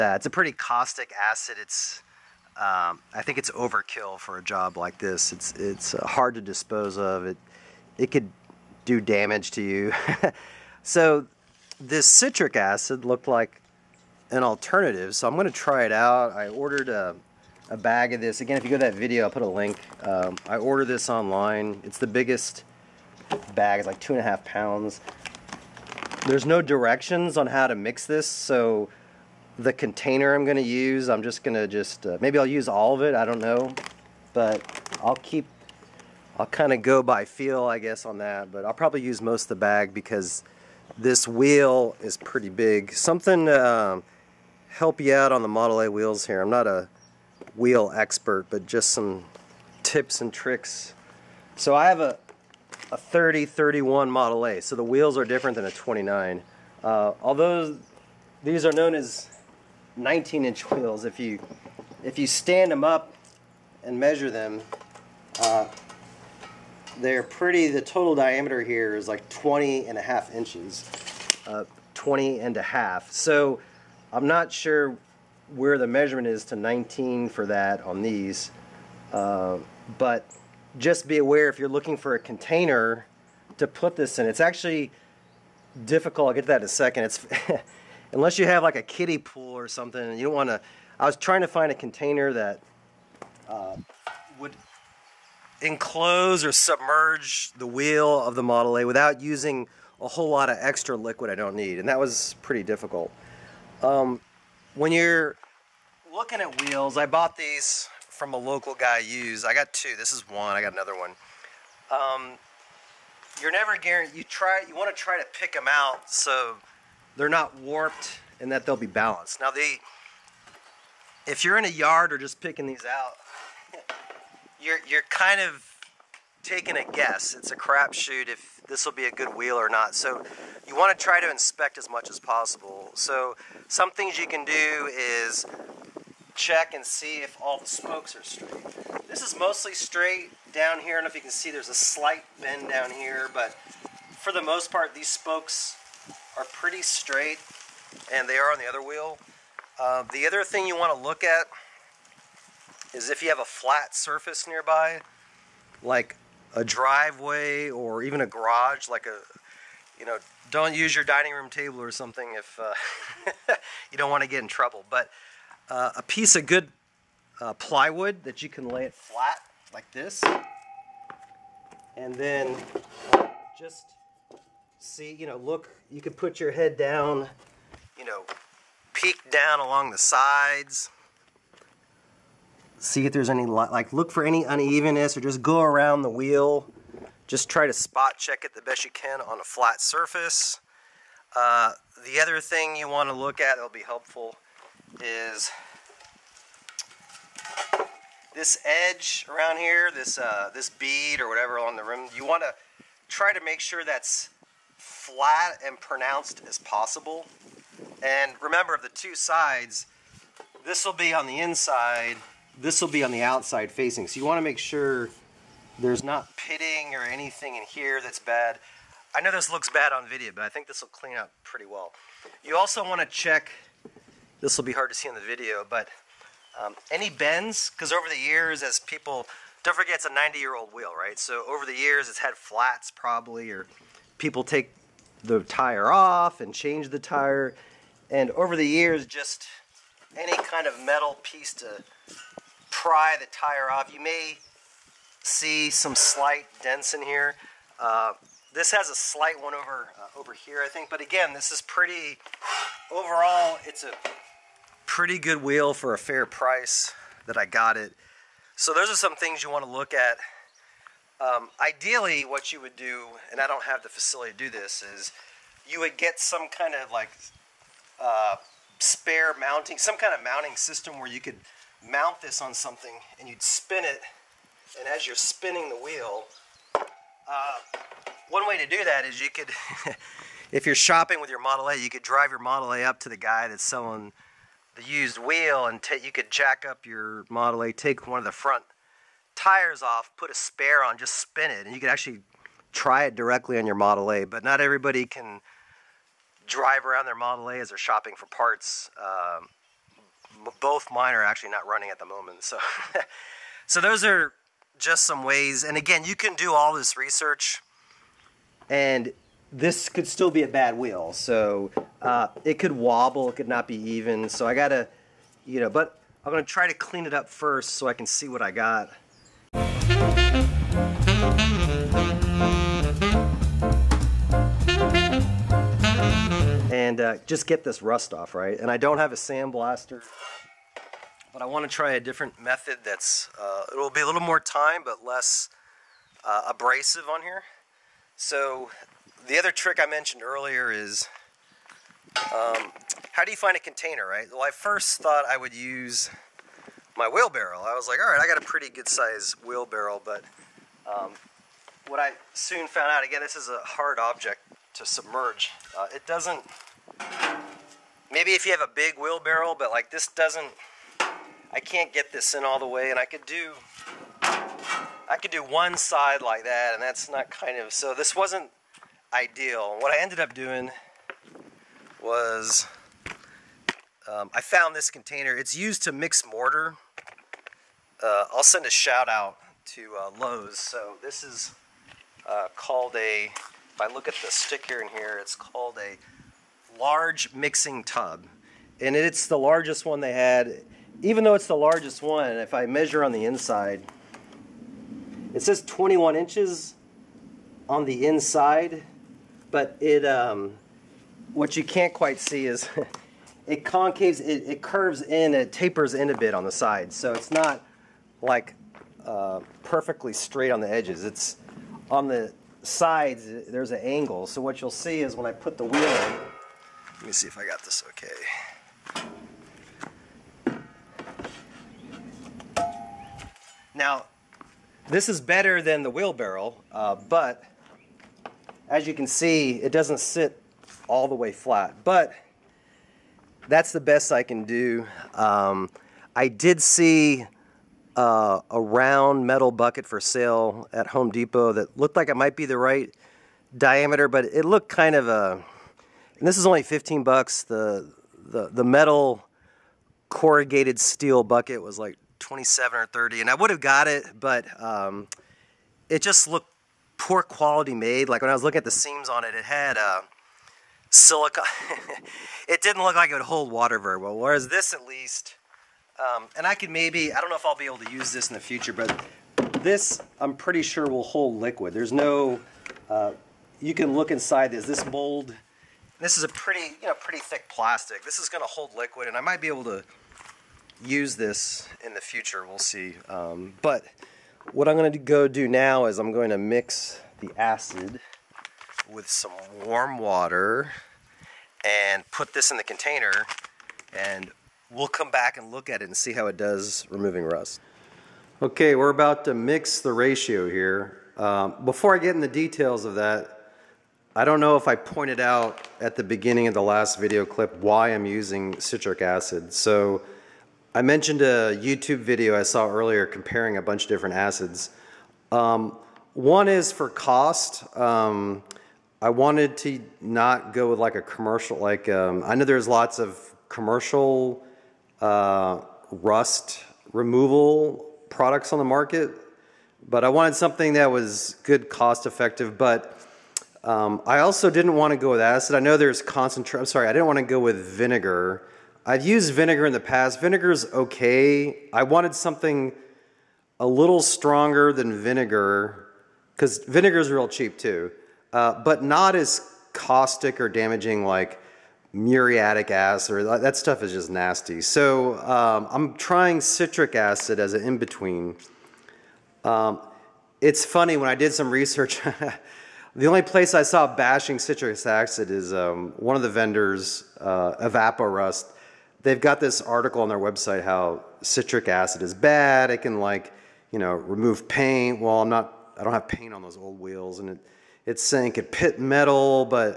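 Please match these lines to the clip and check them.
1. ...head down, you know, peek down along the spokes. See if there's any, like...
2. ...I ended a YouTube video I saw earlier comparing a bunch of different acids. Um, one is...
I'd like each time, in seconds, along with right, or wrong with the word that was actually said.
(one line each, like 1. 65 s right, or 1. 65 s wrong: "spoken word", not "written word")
1. 176 s wrong: "sides", not "spokes"
2. 510 s wrong: "mentioned", not "ended".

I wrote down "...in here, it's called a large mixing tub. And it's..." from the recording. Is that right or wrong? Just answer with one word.
right.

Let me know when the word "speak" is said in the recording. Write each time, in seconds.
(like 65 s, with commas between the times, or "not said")
not said.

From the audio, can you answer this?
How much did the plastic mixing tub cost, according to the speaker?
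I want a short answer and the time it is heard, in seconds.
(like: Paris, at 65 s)
15 dollars, at 446 s.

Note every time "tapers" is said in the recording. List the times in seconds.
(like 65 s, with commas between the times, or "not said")
405 s.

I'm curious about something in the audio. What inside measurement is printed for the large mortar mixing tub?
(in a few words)
21 inches.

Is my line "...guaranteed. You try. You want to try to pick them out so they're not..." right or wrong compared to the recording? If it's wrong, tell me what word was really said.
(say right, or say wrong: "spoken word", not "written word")
right.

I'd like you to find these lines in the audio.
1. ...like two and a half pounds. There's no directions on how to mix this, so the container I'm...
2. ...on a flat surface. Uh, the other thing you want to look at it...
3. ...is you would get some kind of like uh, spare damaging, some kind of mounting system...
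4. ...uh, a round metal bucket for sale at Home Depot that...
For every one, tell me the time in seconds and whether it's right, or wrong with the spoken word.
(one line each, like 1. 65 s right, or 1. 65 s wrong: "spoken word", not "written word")
1. 23 s right
2. 189 s right
3. 264 s wrong: "mounting", not "damaging"
4. 437 s right.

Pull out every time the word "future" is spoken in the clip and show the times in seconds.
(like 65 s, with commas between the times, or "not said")
468 s, 482 s.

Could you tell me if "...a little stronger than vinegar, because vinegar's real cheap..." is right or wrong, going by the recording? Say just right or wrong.
right.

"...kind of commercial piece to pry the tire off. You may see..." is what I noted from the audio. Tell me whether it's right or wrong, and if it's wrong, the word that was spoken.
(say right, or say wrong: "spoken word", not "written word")
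wrong: "metal", not "commercial".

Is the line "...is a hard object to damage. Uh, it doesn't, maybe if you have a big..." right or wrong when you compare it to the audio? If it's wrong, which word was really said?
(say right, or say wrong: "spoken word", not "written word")
wrong: "submerge", not "damage".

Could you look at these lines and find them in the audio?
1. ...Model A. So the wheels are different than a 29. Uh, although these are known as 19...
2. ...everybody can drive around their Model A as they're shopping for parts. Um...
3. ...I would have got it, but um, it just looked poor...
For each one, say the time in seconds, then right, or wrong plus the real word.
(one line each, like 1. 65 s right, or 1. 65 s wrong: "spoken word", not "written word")
1. 54 s right
2. 294 s right
3. 453 s right.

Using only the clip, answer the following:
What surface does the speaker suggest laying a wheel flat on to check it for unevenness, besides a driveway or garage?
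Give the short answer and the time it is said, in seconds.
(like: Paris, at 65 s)
plywood, at 167 s.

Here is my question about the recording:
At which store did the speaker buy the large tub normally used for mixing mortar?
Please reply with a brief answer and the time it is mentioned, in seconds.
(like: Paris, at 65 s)
Lowe's, at 380 s.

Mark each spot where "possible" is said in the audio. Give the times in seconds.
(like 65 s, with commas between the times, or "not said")
132 s, 206 s.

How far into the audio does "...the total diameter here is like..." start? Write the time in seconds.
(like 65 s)
67 s.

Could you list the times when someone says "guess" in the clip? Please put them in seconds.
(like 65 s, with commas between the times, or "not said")
37 s, 126 s.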